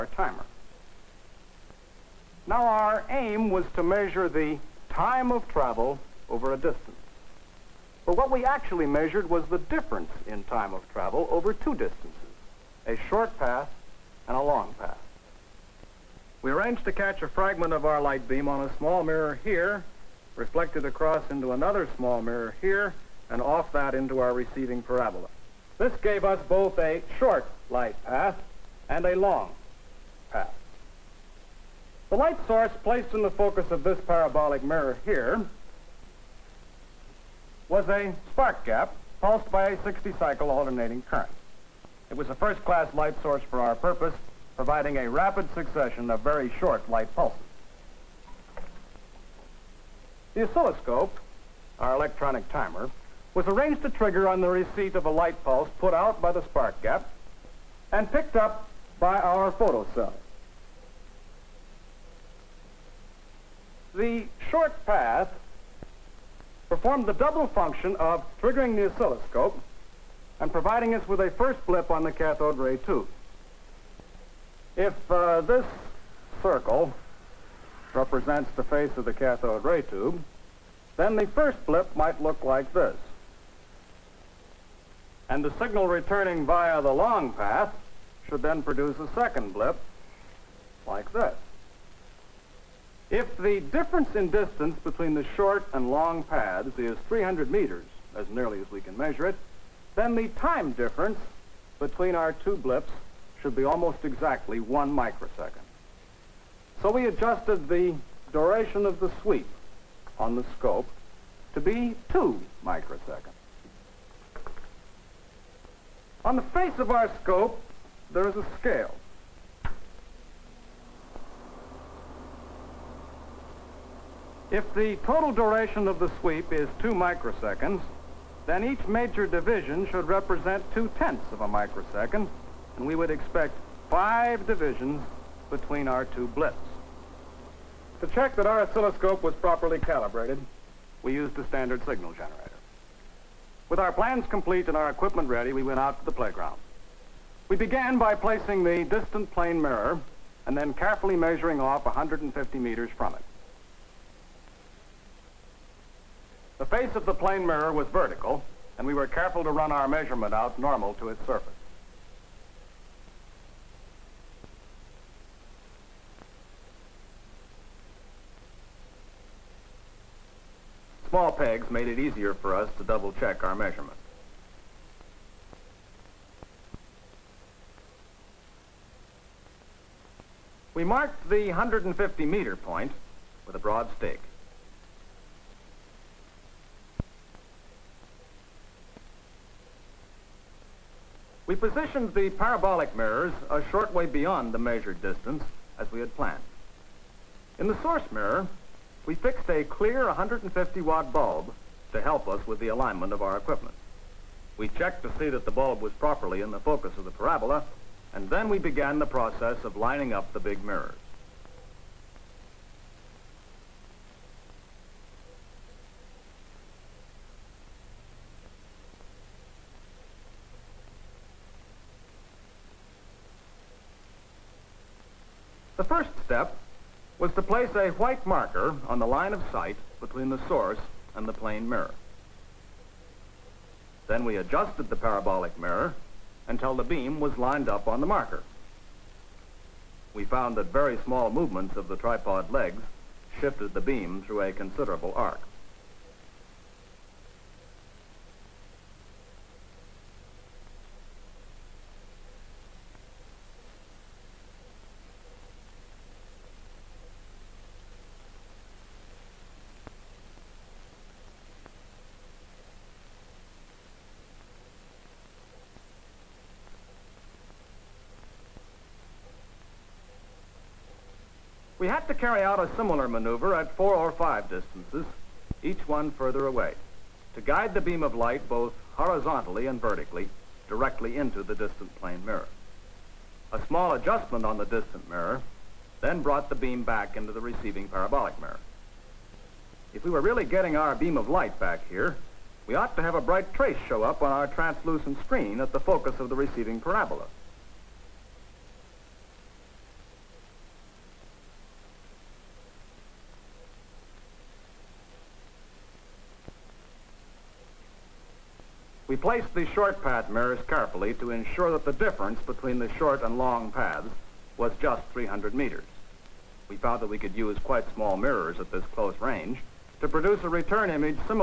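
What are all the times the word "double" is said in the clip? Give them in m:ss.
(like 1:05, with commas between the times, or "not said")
1:07, 2:52.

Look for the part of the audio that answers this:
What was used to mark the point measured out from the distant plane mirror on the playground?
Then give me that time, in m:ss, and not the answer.
3:03.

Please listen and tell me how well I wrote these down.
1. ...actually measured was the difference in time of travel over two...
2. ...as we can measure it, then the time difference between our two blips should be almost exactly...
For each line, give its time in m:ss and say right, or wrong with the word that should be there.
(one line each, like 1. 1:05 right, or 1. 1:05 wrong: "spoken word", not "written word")
1. 0:08 right
2. 1:38 right.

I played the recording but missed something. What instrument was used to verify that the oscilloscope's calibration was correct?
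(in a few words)
Standard signal generator.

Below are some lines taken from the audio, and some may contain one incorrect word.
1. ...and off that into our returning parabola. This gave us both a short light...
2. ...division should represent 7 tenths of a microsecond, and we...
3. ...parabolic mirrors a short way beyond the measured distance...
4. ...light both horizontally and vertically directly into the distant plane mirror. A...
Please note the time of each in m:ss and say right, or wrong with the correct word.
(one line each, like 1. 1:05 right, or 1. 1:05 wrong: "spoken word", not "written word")
1. 0:23 wrong: "receiving", not "returning"
2. 2:09 wrong: "2", not "7"
3. 3:12 right
4. 4:38 right.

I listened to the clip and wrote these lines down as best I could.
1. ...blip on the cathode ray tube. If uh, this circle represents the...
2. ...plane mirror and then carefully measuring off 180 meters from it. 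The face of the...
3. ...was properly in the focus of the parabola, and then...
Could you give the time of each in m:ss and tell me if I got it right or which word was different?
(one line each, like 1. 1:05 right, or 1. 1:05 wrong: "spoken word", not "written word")
1. 1:11 right
2. 2:29 wrong: "150", not "180"
3. 3:25 right.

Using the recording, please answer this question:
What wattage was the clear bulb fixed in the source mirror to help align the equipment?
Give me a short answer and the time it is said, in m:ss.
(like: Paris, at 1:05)
150 watt, at 3:20.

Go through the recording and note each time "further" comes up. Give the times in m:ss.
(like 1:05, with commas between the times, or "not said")
4:36.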